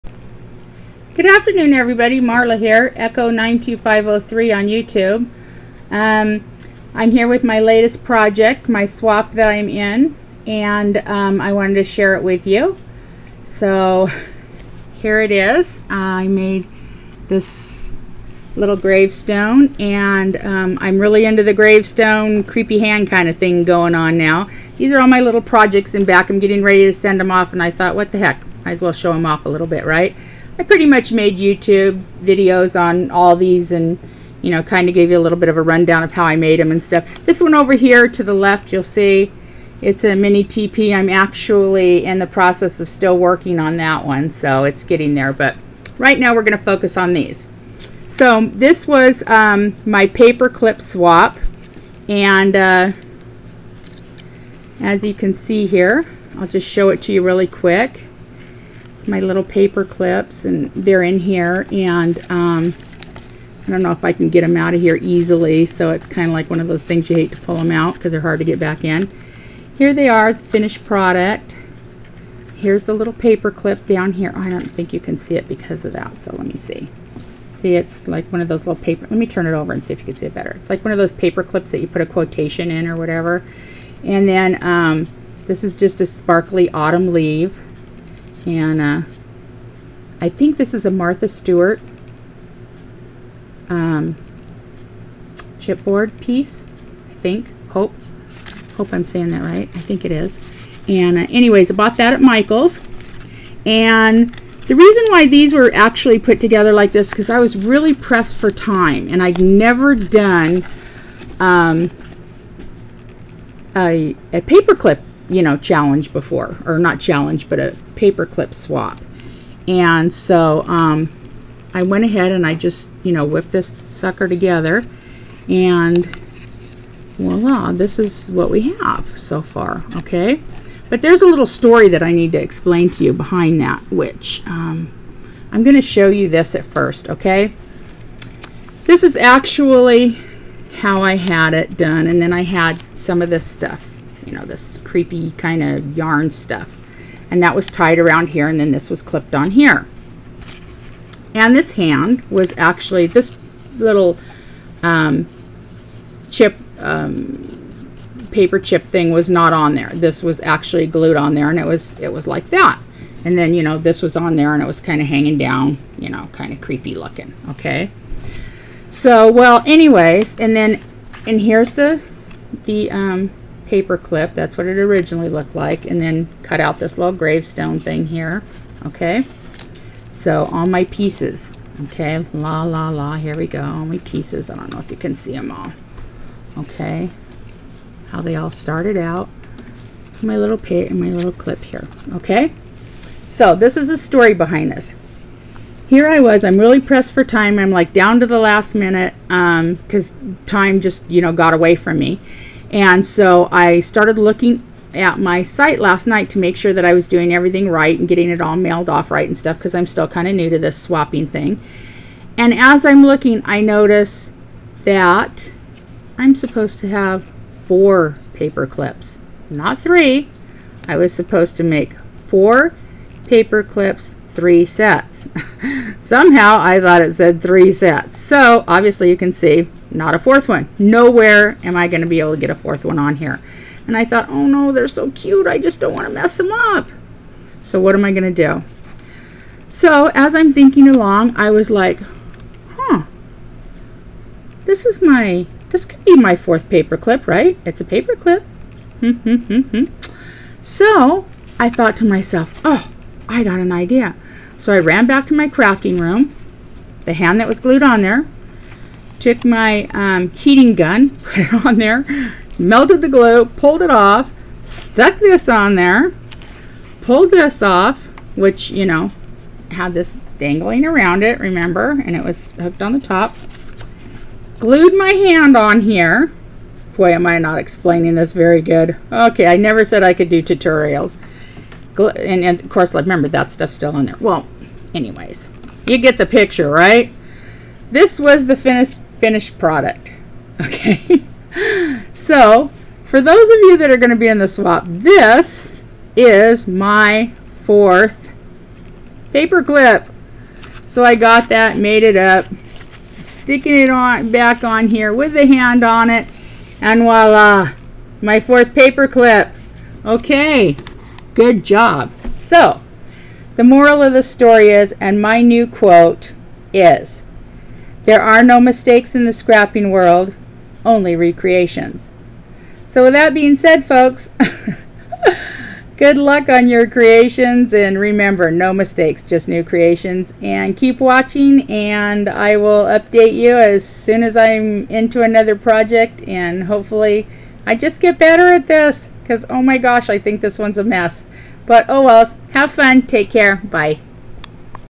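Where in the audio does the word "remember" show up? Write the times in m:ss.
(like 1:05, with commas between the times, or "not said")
4:31, 4:42, 5:27.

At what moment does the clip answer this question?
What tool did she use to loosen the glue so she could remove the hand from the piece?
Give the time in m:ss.
4:20.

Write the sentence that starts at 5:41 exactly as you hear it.
But oh well, have fun, take care, bye.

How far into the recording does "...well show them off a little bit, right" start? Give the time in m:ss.
0:28.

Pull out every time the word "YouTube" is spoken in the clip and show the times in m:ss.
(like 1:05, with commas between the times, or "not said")
0:04, 0:31.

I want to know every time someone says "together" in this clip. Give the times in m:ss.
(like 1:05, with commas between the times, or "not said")
1:46, 2:04.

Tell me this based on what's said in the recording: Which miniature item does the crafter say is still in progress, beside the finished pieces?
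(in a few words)
mini TP.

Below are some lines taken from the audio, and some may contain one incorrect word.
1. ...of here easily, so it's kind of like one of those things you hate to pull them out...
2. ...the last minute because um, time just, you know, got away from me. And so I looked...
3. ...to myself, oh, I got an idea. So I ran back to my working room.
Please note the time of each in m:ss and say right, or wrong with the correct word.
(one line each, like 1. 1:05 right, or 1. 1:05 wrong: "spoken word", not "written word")
1. 1:04 right
2. 3:18 wrong: "started", not "looked"
3. 4:11 wrong: "crafting", not "working".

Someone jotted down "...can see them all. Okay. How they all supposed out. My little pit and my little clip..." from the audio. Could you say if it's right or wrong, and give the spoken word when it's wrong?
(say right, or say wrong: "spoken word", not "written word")
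wrong: "started", not "supposed".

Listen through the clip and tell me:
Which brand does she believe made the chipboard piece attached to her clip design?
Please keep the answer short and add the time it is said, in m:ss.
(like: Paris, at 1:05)
Martha Stewart, at 1:30.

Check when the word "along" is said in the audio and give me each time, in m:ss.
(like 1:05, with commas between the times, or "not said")
4:00.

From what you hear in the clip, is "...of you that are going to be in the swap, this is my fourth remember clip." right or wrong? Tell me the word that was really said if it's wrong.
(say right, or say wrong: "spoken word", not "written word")
wrong: "paper", not "remember".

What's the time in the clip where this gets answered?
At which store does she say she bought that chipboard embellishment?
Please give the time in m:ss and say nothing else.
1:42.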